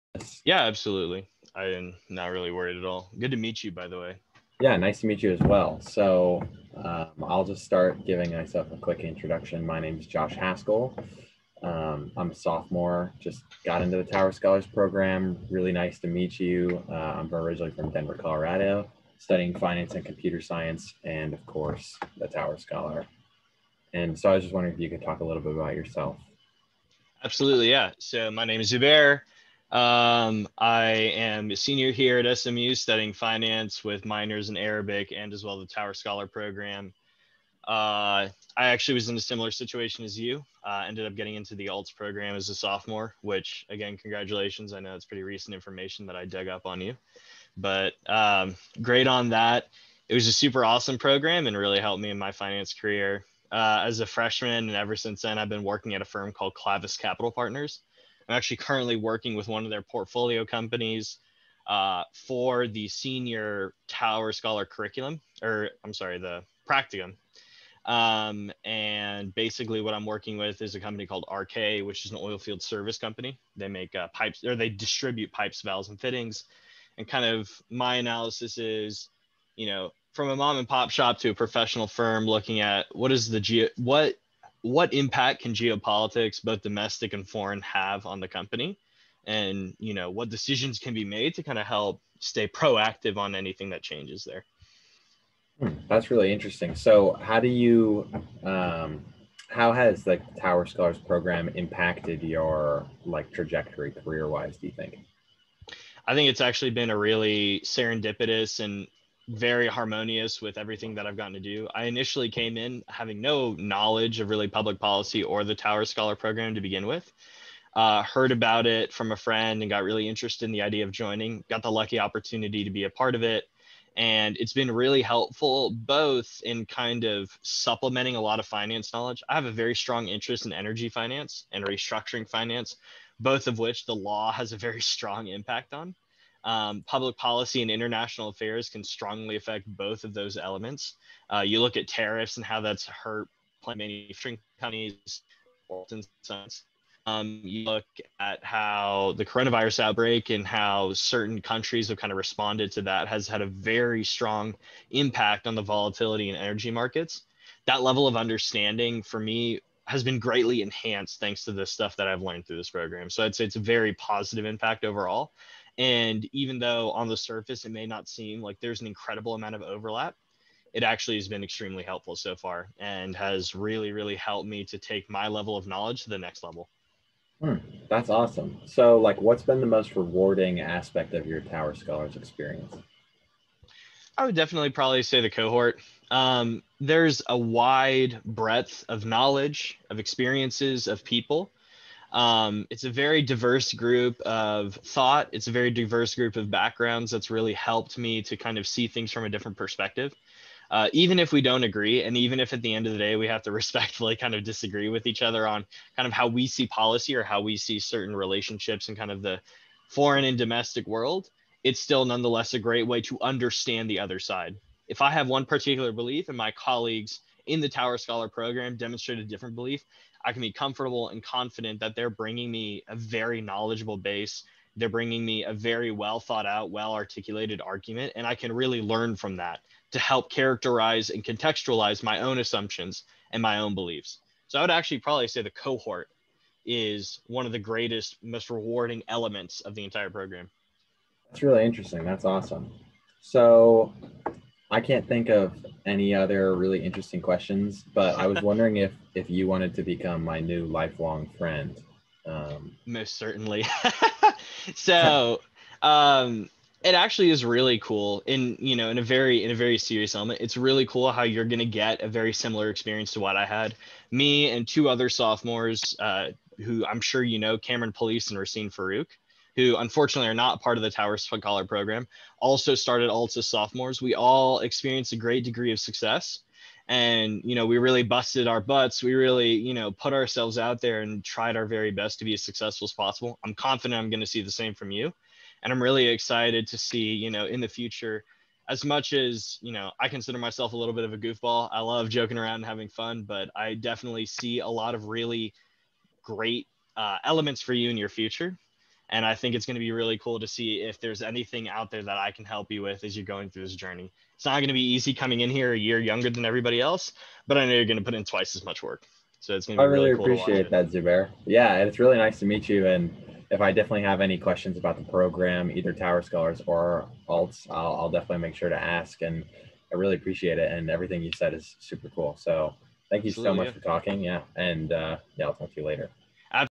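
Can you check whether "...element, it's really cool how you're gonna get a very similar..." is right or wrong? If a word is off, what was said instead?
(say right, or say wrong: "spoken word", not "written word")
right.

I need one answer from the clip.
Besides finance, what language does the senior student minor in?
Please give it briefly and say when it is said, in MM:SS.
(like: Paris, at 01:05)
Arabic, at 00:34.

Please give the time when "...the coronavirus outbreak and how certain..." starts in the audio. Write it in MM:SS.
02:29.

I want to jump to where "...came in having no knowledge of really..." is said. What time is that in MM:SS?
01:52.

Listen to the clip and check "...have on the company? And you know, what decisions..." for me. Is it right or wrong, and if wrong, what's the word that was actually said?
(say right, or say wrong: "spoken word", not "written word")
right.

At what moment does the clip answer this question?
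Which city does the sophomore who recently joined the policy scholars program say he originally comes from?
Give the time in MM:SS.
00:17.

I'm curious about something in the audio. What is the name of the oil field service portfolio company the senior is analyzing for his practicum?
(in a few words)
RK.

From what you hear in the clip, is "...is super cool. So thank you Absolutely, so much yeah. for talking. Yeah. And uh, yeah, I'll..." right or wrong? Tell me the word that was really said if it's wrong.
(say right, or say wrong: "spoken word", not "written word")
right.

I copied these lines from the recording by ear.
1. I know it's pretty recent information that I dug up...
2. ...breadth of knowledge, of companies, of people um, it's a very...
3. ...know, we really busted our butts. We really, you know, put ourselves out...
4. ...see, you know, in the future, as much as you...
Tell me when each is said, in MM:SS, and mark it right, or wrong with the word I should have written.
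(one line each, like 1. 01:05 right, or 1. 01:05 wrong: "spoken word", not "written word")
1. 00:44 right
2. 03:08 wrong: "experiences", not "companies"
3. 04:37 right
4. 04:46 right.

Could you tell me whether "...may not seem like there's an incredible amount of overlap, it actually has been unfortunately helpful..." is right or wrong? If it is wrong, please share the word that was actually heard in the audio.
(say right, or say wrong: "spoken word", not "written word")
wrong: "extremely", not "unfortunately".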